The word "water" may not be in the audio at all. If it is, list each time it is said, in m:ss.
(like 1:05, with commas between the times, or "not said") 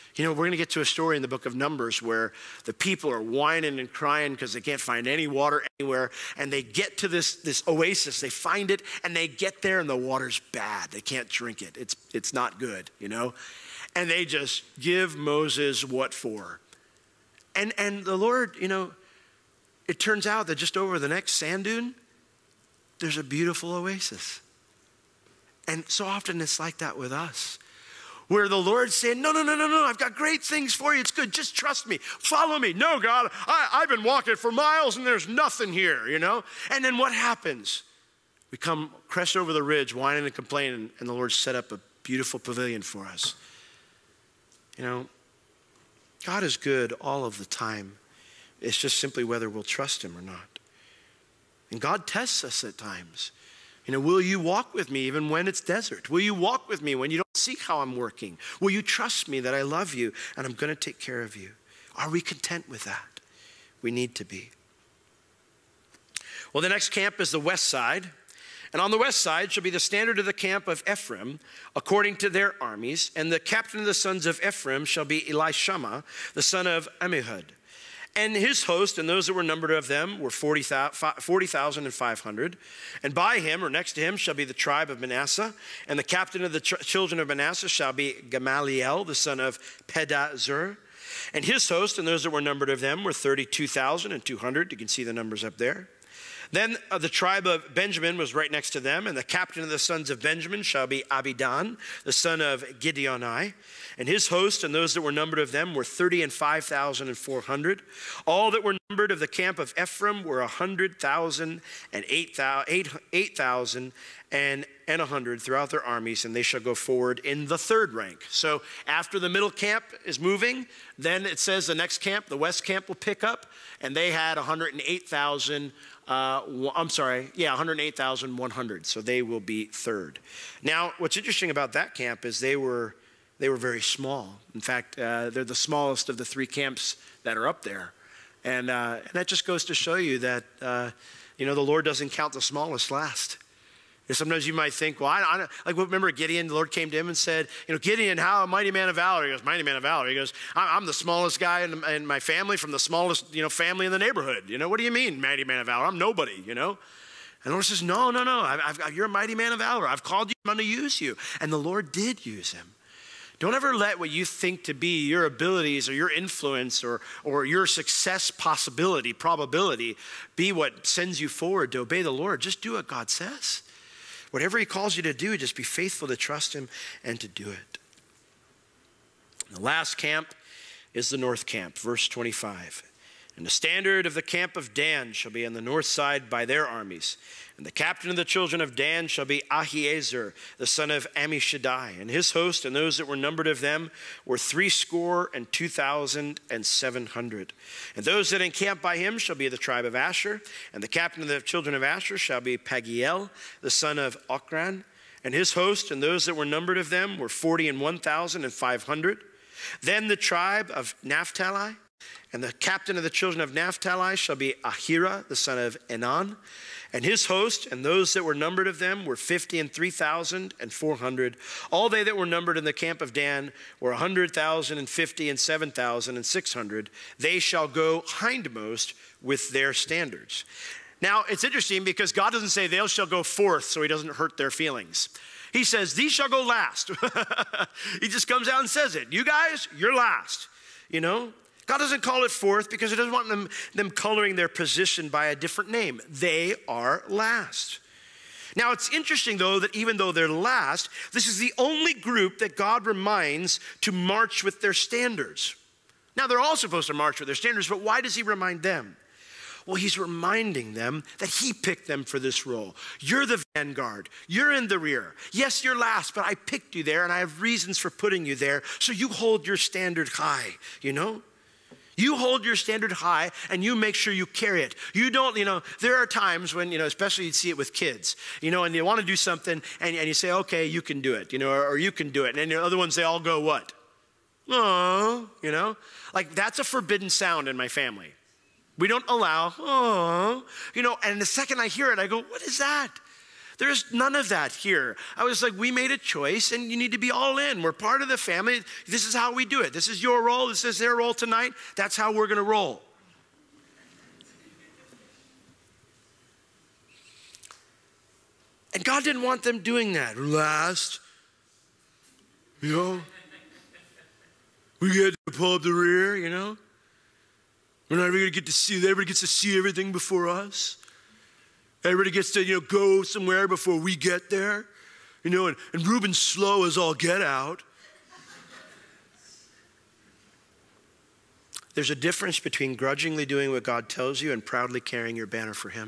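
0:05, 0:09.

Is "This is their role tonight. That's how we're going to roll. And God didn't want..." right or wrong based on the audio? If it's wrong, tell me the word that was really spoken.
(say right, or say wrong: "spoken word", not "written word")
right.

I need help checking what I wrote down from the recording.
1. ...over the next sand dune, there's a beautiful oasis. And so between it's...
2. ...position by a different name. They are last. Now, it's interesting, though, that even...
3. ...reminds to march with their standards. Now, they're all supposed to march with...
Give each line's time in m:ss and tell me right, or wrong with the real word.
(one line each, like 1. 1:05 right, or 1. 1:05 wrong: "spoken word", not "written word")
1. 0:20 wrong: "often", not "between"
2. 4:04 right
3. 4:12 right.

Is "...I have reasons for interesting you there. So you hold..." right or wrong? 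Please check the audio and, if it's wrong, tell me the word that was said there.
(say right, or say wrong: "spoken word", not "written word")
wrong: "putting", not "interesting".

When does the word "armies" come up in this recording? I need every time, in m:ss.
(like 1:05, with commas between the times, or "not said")
1:12, 1:55, 3:06.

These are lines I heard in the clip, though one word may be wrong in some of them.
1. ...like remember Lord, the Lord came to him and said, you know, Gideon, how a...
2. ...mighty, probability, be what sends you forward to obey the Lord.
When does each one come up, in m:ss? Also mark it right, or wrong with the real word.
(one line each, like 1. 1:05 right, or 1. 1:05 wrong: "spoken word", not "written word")
1. 2:25 wrong: "Gideon", not "Lord"
2. 2:48 wrong: "possibility", not "mighty".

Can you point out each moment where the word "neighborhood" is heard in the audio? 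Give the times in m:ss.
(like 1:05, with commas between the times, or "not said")
2:33.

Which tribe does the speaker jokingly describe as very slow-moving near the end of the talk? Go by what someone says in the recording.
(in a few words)
Reuben.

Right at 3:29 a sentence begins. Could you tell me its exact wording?
Then the tribe of Naphtali and the captain of the children of Naphtali shall be Ahira, the son of Enan.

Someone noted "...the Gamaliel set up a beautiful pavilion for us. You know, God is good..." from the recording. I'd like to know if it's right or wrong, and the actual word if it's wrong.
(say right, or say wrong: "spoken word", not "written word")
wrong: "Lord", not "Gamaliel".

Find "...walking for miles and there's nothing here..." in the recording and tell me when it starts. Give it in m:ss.
0:34.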